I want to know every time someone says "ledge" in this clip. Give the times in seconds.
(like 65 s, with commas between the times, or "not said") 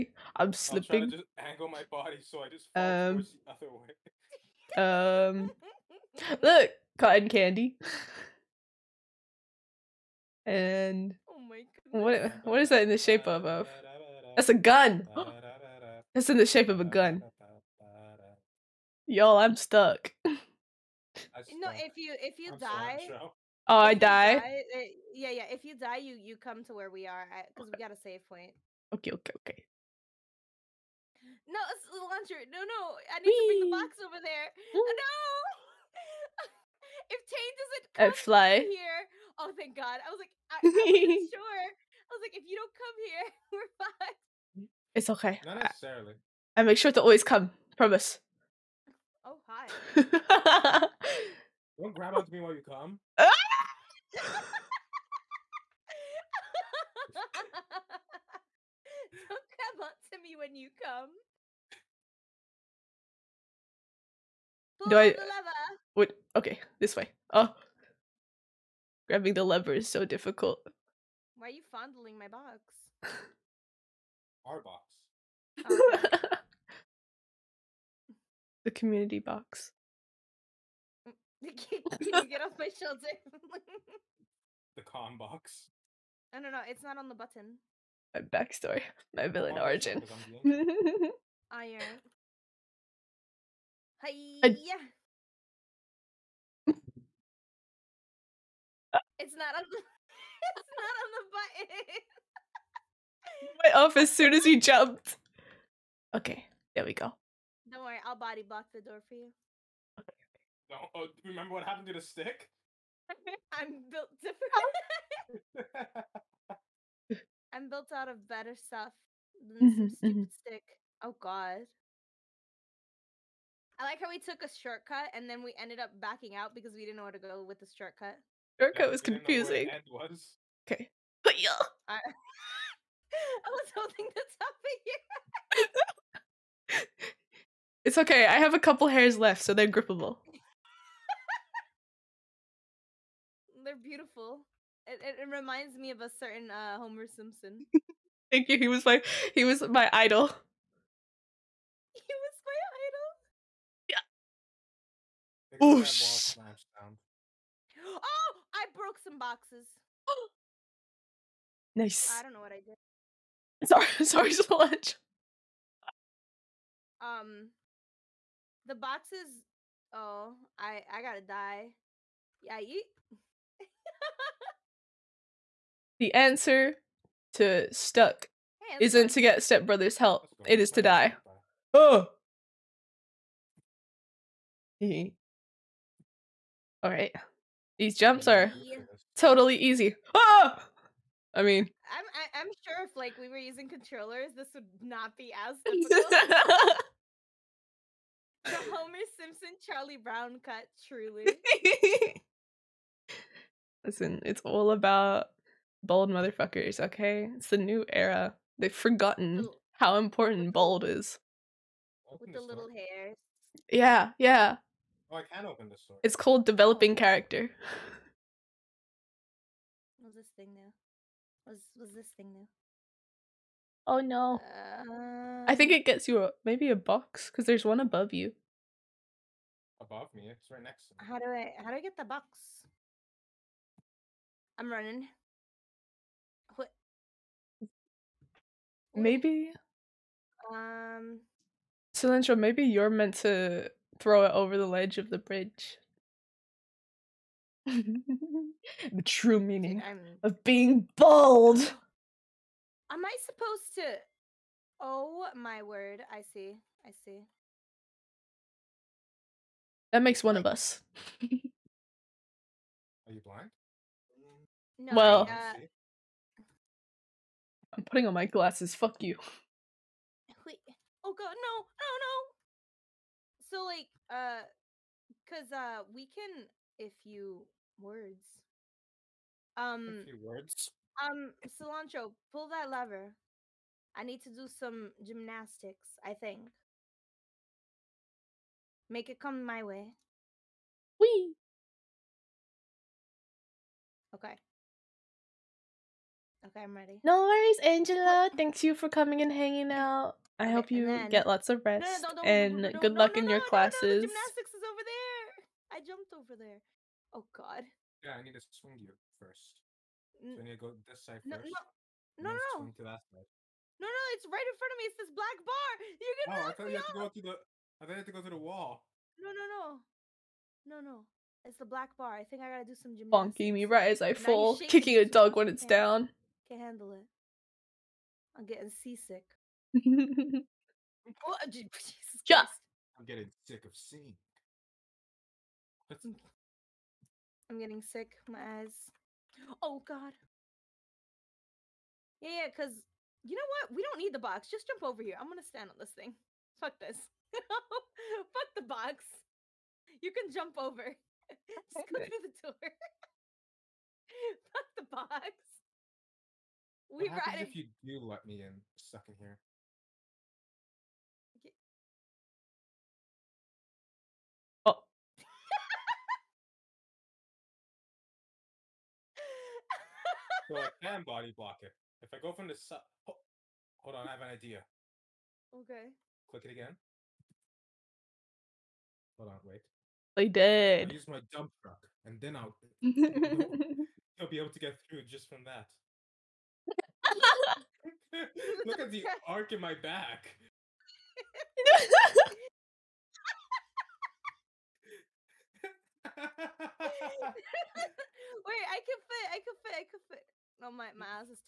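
244 s.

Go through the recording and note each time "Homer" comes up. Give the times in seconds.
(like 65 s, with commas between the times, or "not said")
146 s, 198 s.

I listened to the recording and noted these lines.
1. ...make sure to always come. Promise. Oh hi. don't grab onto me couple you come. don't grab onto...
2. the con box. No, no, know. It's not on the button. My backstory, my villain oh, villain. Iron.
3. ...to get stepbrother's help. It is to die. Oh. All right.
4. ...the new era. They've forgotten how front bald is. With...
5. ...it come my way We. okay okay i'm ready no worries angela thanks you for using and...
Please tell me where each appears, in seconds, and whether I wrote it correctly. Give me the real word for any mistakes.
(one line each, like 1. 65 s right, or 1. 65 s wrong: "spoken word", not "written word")
1. 46 s wrong: "while", not "couple"
2. 84 s wrong: "origin", not "villain"
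3. 179 s right
4. 207 s wrong: "important", not "front"
5. 289 s wrong: "coming", not "using".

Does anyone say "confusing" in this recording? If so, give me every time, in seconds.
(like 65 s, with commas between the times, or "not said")
129 s.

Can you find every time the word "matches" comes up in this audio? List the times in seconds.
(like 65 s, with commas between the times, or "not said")
not said.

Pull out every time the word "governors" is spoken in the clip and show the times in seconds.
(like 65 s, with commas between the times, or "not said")
not said.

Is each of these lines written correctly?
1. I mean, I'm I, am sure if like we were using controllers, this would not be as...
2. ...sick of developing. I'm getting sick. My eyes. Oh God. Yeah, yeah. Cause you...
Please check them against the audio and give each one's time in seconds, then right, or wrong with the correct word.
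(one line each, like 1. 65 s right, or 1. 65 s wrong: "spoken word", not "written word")
1. 191 s right
2. 333 s wrong: "seeing", not "developing".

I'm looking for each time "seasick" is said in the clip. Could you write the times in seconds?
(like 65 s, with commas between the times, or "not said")
328 s.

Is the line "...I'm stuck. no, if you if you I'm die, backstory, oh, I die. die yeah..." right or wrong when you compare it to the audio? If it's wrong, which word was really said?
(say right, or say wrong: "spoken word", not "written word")
wrong: "sorry", not "backstory".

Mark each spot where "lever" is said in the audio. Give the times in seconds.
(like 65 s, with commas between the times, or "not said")
65 s, 69 s, 282 s.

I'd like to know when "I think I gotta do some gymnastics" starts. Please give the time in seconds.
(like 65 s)
322 s.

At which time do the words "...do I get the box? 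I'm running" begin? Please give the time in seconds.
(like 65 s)
231 s.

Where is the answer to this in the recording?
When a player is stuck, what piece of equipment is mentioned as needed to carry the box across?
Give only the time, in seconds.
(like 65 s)
31 s.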